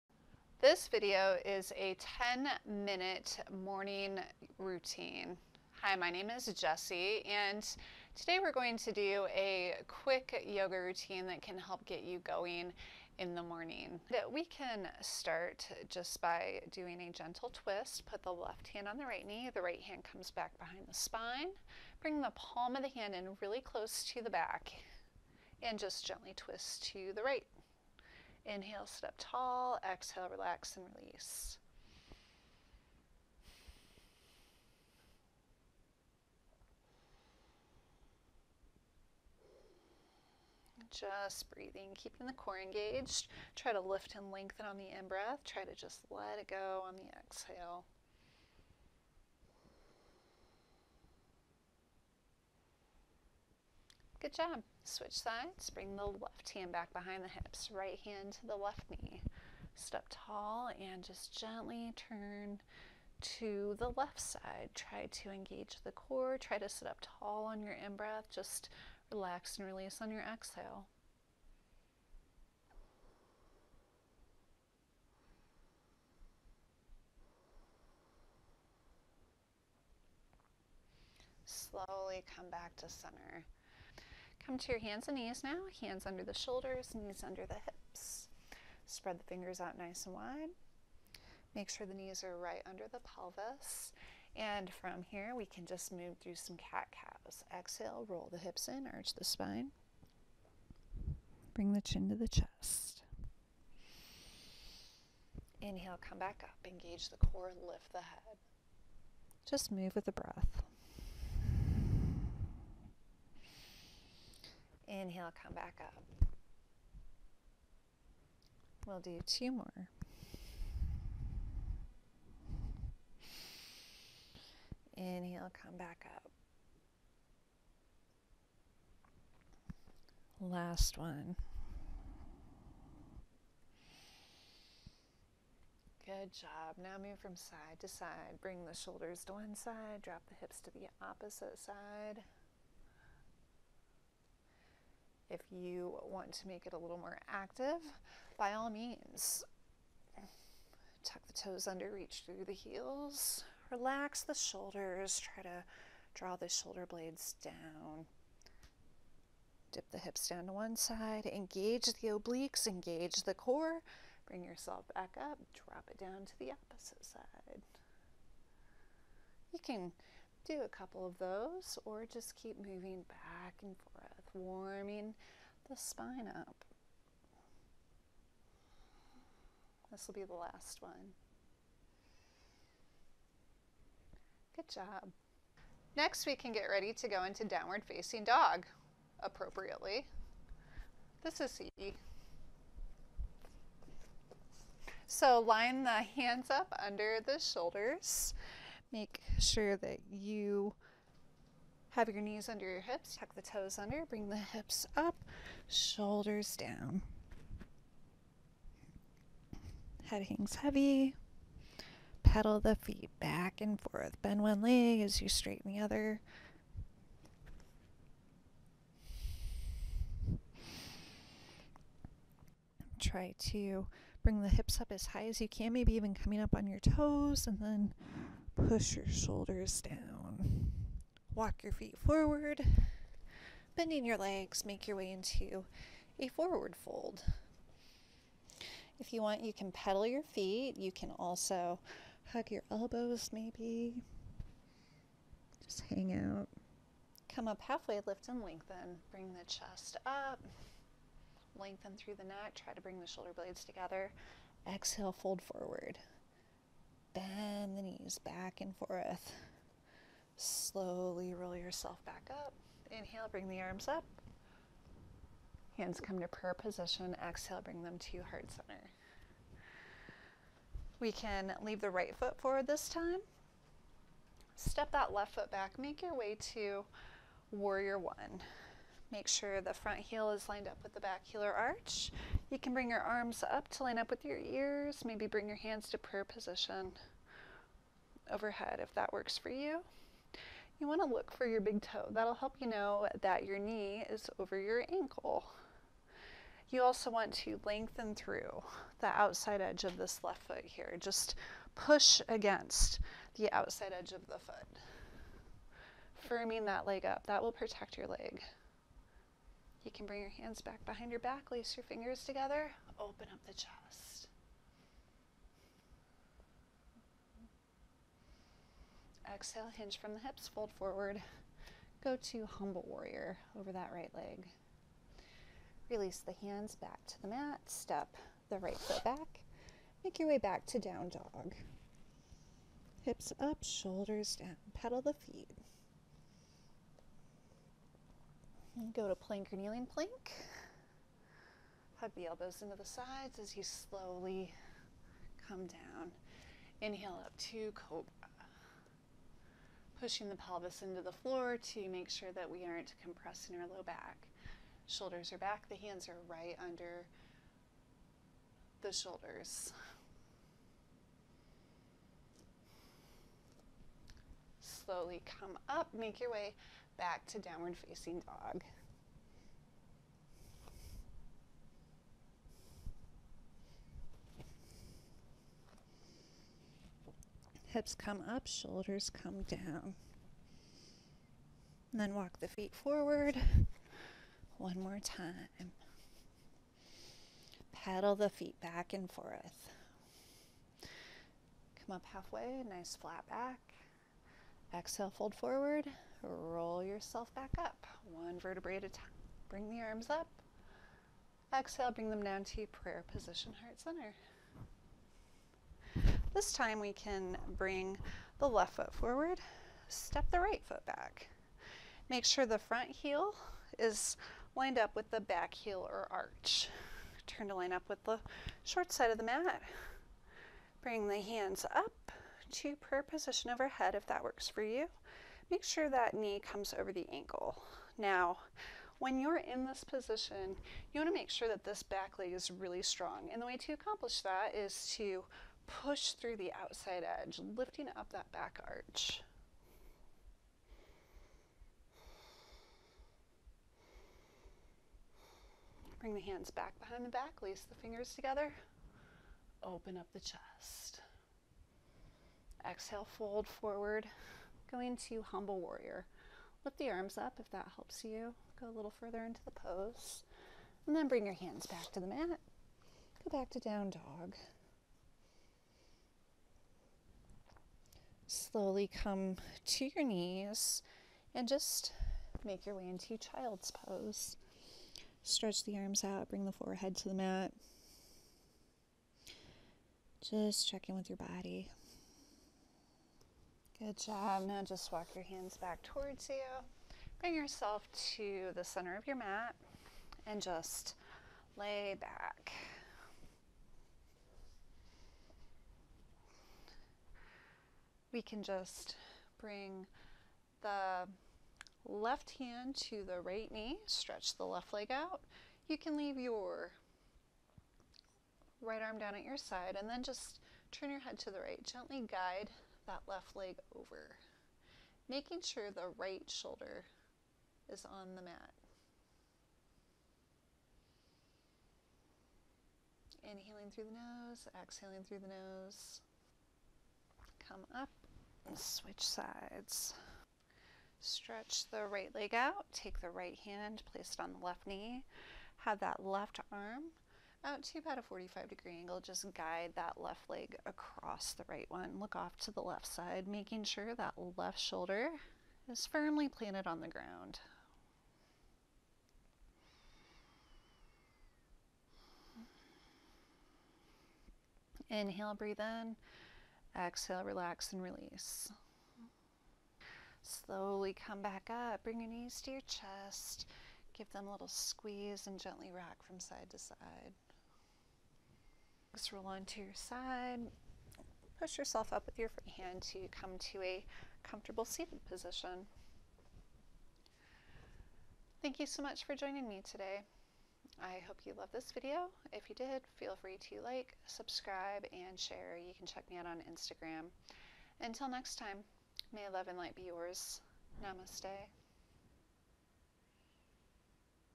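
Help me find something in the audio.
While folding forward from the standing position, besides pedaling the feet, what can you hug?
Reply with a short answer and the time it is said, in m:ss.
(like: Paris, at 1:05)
Your elbows, at 4:02.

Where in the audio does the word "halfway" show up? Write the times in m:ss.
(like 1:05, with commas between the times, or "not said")
4:07, 6:32.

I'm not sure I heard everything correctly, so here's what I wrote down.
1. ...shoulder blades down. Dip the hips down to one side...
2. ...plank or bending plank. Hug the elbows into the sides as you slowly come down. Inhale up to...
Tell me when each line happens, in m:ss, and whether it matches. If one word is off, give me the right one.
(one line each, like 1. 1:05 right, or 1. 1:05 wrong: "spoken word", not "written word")
1. 2:36 right
2. 5:39 wrong: "kneeling", not "bending".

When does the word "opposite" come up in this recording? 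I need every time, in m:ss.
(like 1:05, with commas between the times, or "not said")
2:21, 2:46.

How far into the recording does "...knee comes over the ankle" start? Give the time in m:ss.
7:06.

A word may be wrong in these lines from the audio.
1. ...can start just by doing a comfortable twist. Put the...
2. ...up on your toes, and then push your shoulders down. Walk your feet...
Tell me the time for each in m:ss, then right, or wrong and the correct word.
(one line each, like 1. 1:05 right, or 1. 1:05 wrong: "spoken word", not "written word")
1. 0:14 wrong: "gentle", not "comfortable"
2. 3:46 right.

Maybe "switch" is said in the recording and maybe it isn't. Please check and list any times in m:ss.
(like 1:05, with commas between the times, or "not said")
0:54, 8:48.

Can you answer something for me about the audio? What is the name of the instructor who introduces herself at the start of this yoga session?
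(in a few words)
Jessie.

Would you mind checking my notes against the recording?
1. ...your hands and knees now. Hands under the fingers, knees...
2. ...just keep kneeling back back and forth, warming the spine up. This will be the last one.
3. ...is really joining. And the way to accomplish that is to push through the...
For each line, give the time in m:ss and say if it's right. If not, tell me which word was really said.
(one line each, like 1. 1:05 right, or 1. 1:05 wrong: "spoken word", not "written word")
1. 1:24 wrong: "shoulders", not "fingers"
2. 2:52 wrong: "moving", not "kneeling"
3. 7:12 wrong: "strong", not "joining".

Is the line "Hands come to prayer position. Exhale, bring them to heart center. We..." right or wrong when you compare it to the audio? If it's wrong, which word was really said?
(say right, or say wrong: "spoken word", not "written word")
right.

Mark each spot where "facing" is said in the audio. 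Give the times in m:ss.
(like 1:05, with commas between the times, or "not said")
3:07, 6:07.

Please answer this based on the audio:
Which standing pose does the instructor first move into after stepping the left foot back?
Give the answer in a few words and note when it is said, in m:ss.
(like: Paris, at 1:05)
Warrior one, at 4:37.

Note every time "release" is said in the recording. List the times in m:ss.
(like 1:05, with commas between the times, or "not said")
0:30, 1:09, 5:25, 9:17.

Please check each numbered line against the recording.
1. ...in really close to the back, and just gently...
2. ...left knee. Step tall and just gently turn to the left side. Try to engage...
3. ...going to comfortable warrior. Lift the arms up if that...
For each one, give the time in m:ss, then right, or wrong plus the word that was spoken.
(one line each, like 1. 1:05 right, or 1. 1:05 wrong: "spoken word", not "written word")
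1. 0:23 right
2. 0:58 right
3. 7:34 wrong: "humble", not "comfortable".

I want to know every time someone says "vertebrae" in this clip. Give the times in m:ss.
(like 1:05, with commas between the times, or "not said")
6:38.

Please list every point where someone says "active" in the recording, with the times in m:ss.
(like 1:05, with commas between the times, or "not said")
2:27.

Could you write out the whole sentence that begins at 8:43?
Inhaling through the nose, exhaling through the nose.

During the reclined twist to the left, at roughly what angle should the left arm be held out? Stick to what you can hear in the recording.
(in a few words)
45 degrees.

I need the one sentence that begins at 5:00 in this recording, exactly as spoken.
Just push against the outside edge of the foot.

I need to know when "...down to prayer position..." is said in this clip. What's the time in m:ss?
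6:42.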